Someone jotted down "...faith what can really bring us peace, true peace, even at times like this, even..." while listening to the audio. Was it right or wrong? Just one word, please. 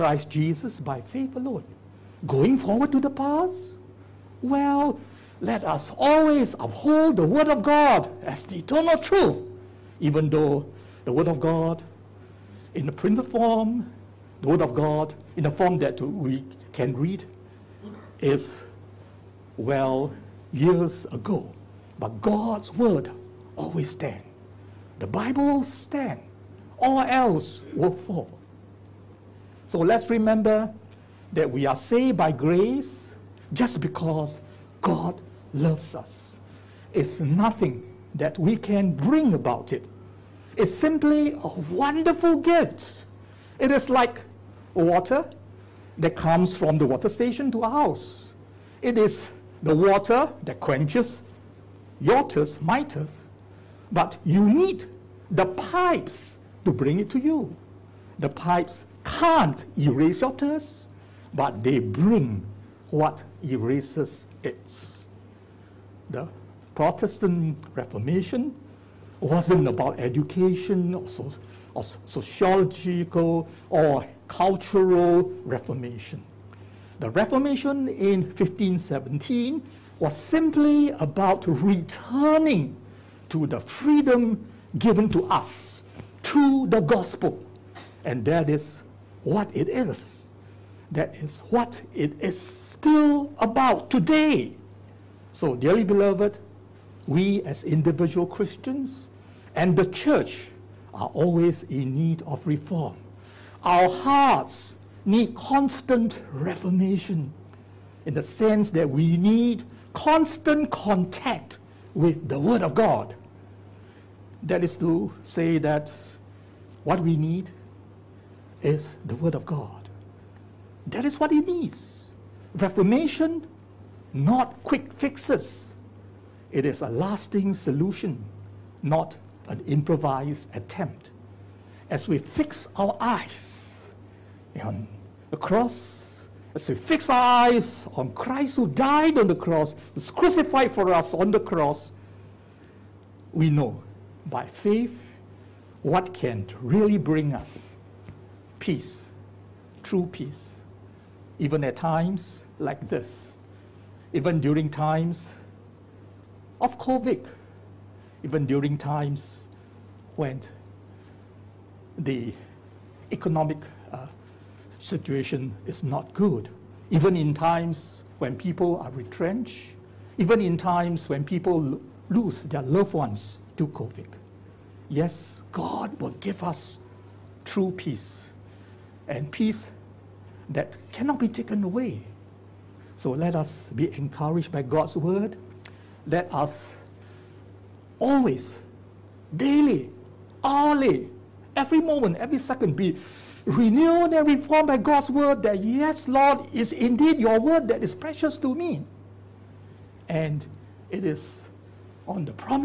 right.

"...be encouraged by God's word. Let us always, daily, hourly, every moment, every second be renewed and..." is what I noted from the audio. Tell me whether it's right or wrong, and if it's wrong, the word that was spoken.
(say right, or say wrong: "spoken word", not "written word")
right.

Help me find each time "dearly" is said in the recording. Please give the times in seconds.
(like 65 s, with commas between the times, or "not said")
95 s.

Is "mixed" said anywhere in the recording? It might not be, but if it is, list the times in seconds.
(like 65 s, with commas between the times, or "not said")
not said.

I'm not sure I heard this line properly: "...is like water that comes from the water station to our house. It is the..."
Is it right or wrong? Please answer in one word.
right.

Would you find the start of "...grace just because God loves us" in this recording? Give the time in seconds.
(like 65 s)
32 s.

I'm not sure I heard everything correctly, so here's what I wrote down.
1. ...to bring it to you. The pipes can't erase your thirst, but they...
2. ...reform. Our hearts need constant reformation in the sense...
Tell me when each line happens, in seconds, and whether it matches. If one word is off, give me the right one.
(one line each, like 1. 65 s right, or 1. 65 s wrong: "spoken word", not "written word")
1. 56 s right
2. 102 s right.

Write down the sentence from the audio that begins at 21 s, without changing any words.
But God's Word always stands the Bible will stand.